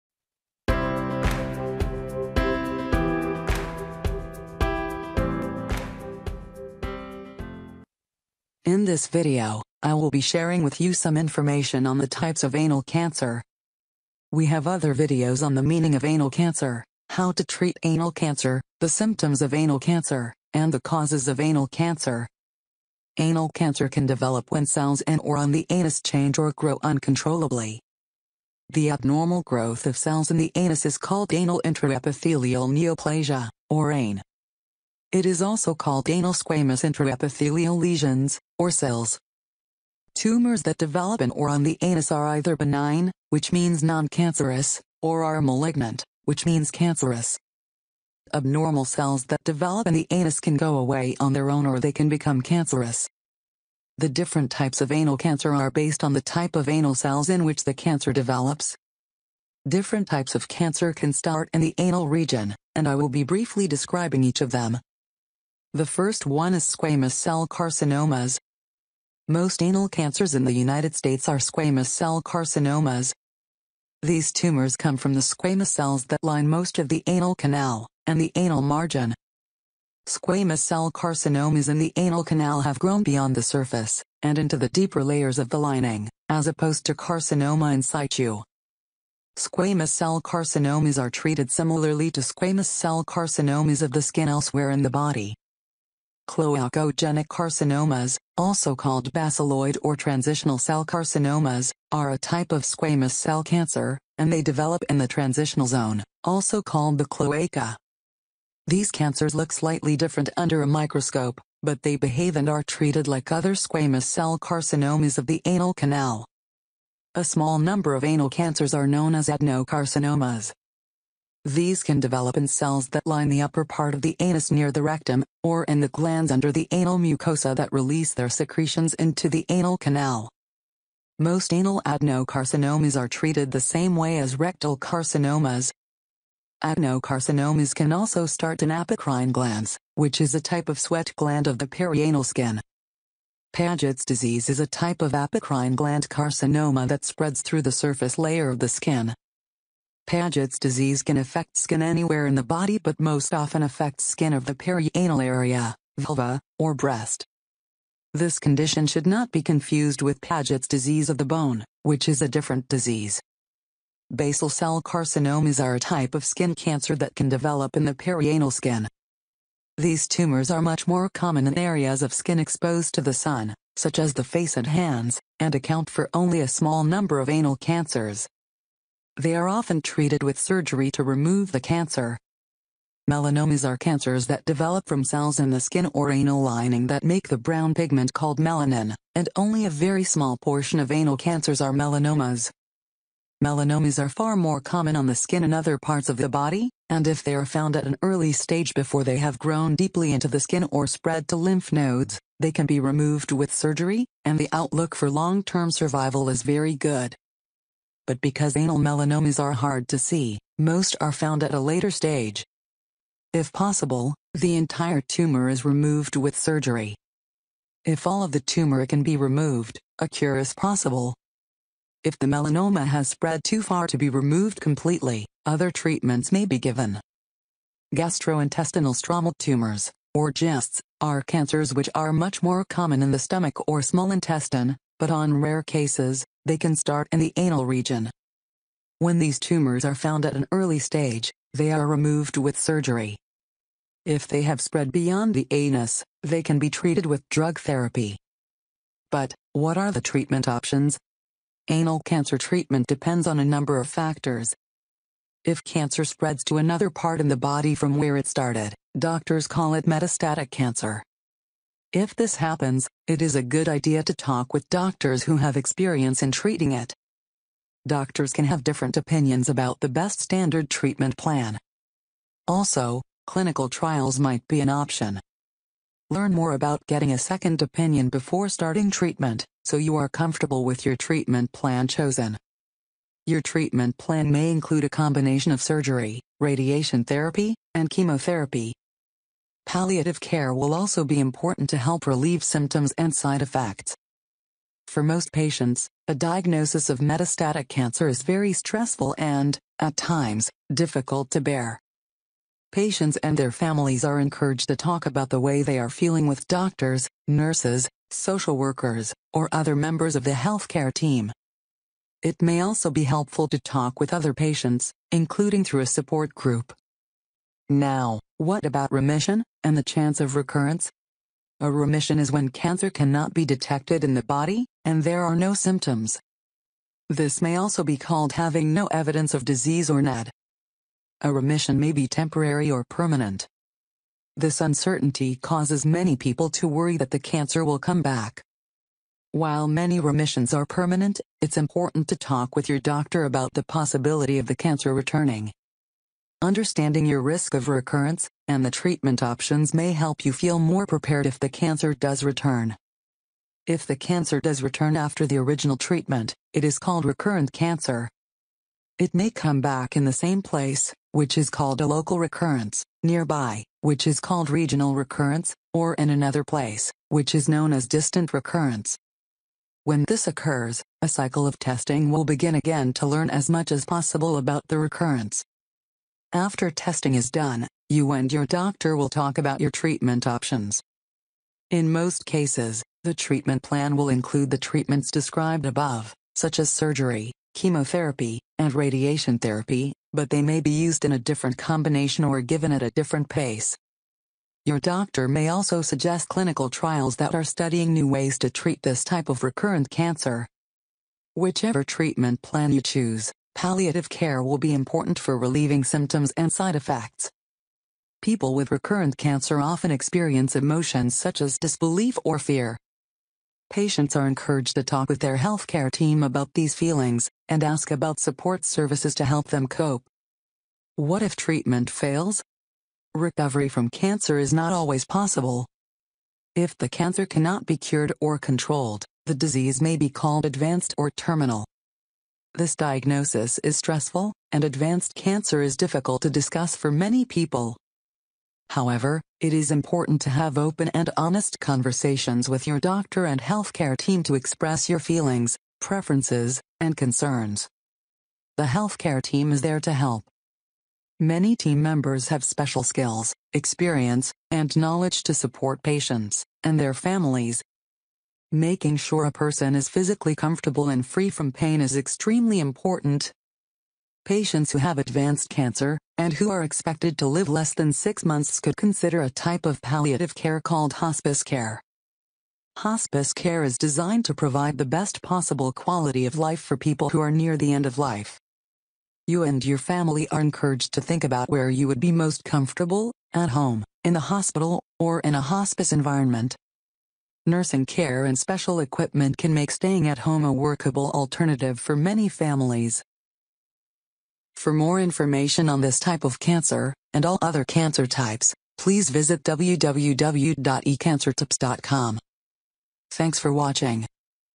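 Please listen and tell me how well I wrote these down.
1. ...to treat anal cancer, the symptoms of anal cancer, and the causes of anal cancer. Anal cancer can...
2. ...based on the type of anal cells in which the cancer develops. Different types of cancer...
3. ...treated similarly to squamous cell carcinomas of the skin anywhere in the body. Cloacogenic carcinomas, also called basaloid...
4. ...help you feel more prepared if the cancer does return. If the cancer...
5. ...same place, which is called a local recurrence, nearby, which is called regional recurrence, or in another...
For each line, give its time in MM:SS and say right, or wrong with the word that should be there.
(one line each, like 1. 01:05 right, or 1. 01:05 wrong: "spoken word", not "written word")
1. 00:17 right
2. 00:55 right
3. 01:31 wrong: "elsewhere", not "anywhere"
4. 05:49 right
5. 06:00 right.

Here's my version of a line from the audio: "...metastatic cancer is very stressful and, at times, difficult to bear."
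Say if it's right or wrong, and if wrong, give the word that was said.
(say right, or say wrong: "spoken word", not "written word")
right.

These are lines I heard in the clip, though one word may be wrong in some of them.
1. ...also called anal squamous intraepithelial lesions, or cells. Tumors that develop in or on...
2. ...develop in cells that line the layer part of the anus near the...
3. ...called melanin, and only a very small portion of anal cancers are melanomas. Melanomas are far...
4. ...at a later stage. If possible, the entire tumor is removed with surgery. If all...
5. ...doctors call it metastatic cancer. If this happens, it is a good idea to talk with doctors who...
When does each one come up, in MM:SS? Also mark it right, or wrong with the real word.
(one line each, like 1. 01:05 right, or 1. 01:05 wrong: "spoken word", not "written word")
1. 00:35 right
2. 02:01 wrong: "upper", not "layer"
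3. 03:08 right
4. 03:31 right
5. 04:18 right.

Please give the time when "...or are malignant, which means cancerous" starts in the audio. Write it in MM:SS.
00:45.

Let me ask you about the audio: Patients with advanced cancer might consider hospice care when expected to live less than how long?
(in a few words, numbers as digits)
6 months.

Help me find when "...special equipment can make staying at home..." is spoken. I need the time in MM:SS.
08:08.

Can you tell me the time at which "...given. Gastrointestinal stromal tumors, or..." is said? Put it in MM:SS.
03:46.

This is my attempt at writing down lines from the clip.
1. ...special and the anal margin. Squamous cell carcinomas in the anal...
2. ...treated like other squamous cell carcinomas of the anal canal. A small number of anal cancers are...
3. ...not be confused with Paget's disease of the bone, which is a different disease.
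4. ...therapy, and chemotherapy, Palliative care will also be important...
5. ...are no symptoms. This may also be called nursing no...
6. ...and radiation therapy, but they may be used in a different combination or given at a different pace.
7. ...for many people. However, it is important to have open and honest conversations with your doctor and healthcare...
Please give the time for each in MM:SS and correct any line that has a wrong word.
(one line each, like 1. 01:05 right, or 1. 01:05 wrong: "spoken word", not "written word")
1. 01:17 wrong: "canal", not "special"
2. 01:52 right
3. 02:39 right
4. 04:47 right
5. 05:25 wrong: "having", not "nursing"
6. 06:28 right
7. 07:16 right.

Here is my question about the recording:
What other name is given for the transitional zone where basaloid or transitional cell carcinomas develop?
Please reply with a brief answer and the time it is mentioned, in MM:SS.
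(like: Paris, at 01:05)
Cloaca, at 01:47.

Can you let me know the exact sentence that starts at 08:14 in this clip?
For more information on this type of cancer, and all other cancer types, please visit www.ecancertips.com.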